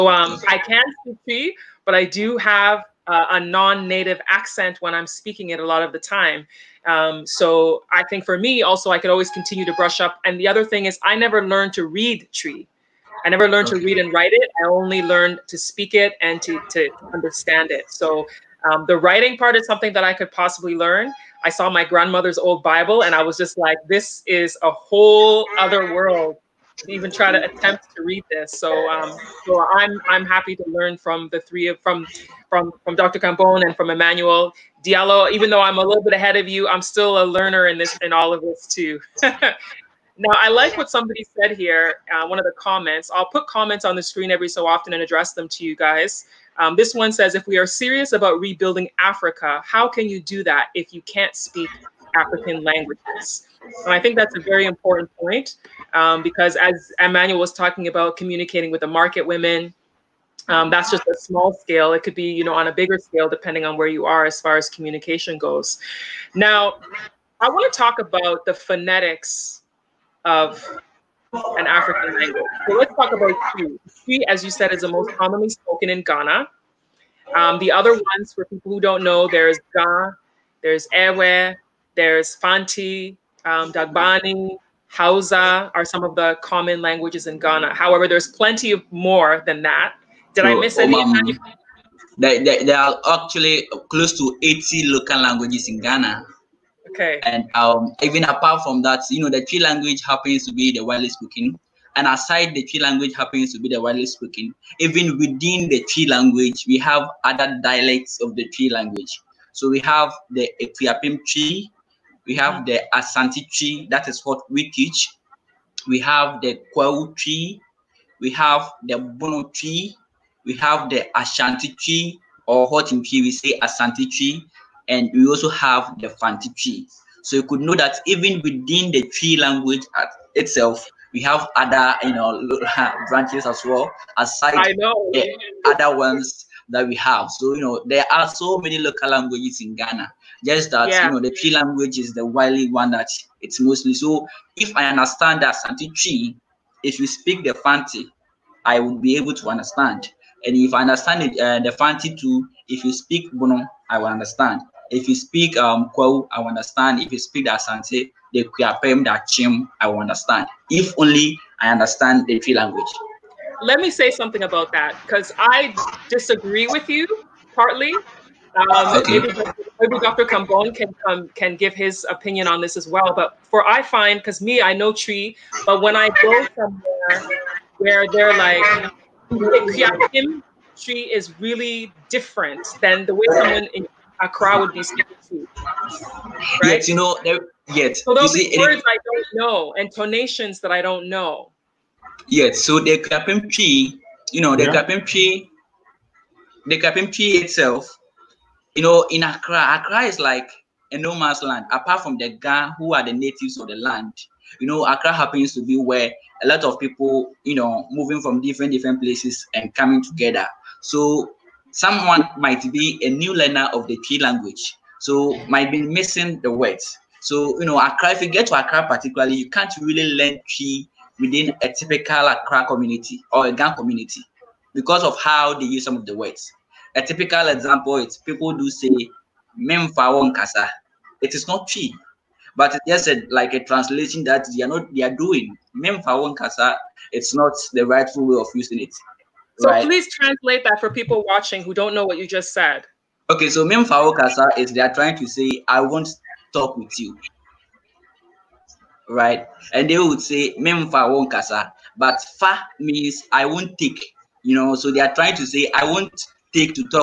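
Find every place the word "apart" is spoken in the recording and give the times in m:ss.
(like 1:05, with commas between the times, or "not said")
1:38, 3:21.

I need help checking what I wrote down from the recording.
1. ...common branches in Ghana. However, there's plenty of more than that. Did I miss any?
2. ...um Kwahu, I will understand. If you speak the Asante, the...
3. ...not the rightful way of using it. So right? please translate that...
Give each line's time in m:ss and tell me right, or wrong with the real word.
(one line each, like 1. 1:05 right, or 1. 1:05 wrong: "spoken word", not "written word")
1. 1:26 wrong: "languages", not "branches"
2. 2:35 right
3. 3:57 right.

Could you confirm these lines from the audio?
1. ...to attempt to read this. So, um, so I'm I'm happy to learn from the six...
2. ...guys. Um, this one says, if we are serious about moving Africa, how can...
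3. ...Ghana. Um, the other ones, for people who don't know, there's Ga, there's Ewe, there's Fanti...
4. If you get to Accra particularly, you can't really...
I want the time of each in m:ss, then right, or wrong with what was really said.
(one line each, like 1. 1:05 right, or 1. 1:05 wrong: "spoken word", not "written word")
1. 0:27 wrong: "three", not "six"
2. 0:45 wrong: "rebuilding", not "moving"
3. 1:16 right
4. 3:38 right.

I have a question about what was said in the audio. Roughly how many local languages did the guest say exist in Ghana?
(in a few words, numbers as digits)
close to 80.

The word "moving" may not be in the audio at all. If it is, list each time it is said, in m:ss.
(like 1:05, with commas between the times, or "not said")
3:27.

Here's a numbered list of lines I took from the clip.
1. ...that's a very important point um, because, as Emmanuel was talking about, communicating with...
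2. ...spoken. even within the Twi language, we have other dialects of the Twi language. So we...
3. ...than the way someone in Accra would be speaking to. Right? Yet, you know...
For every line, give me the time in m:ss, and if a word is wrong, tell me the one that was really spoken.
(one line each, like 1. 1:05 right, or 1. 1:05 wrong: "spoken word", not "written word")
1. 0:54 right
2. 1:44 right
3. 3:02 right.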